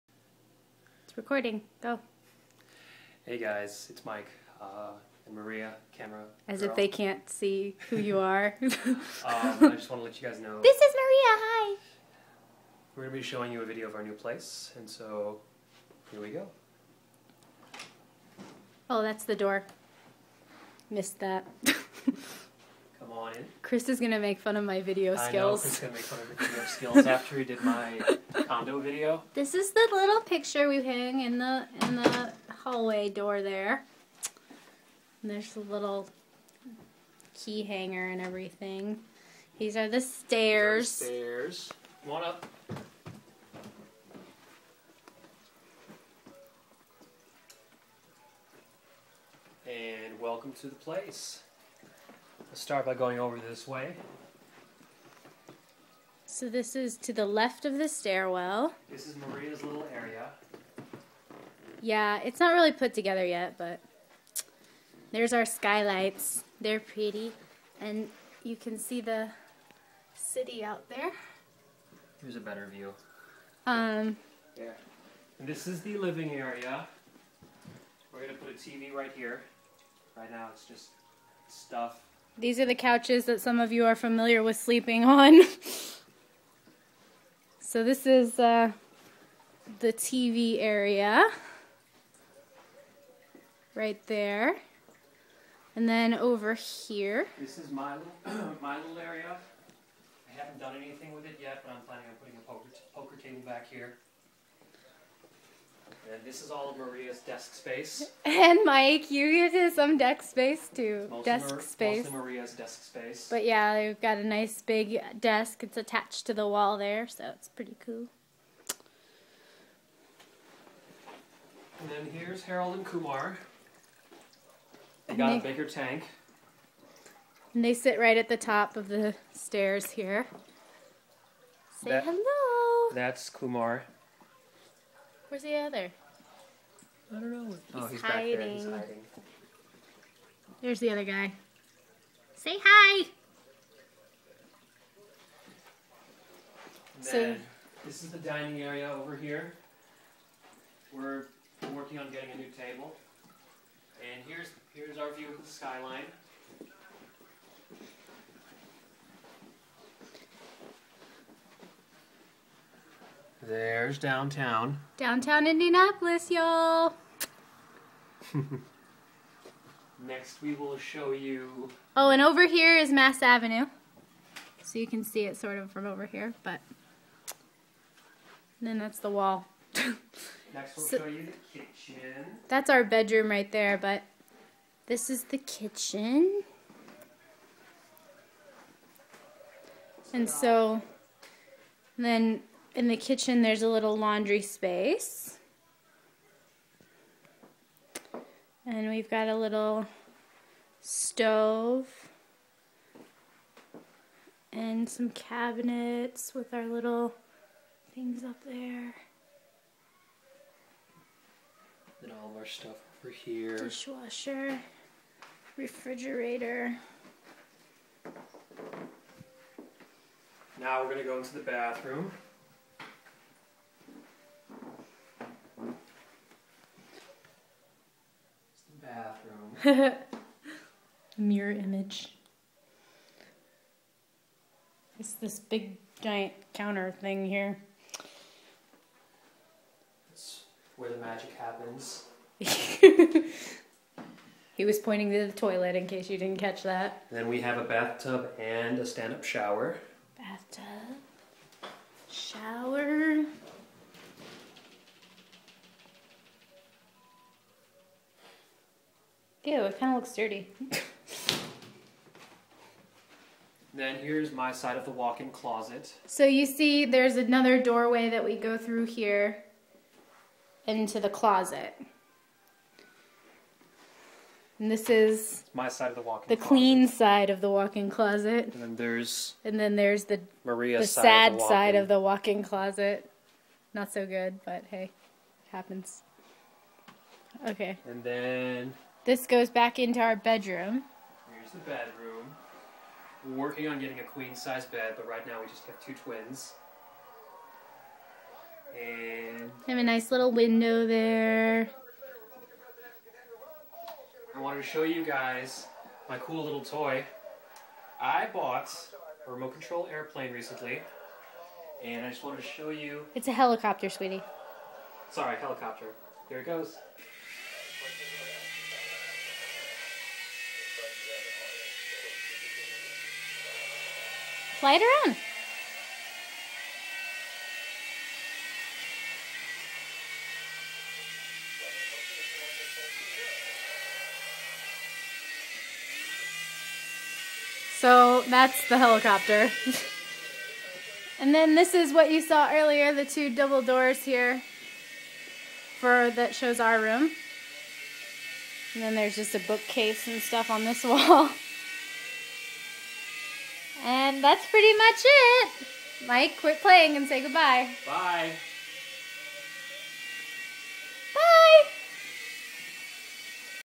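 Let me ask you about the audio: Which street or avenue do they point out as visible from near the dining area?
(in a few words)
Mass Avenue.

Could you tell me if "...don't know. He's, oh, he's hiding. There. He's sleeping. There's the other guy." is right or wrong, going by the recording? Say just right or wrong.
wrong.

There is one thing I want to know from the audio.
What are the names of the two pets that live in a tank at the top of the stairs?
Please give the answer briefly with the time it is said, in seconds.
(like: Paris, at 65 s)
Harold and Kumar, at 122 s.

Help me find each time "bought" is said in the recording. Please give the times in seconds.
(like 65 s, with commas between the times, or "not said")
308 s.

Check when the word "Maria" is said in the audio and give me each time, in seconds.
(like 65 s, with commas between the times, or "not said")
5 s, 10 s, 59 s, 106 s, 112 s, 280 s.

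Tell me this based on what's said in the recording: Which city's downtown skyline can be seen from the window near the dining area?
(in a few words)
Indianapolis.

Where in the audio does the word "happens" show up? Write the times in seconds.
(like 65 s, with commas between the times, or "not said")
241 s, 285 s.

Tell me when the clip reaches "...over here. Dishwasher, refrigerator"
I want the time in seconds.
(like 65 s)
213 s.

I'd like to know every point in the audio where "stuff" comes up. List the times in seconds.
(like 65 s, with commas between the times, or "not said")
81 s, 212 s, 350 s.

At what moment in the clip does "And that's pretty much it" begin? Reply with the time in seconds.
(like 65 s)
353 s.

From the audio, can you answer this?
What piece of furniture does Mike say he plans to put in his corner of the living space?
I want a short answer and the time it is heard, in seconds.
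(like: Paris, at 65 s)
Poker table, at 102 s.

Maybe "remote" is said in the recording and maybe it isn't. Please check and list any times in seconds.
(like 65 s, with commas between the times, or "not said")
309 s.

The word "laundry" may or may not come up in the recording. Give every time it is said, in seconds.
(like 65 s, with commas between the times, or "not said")
193 s.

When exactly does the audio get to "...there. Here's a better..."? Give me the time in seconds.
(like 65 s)
70 s.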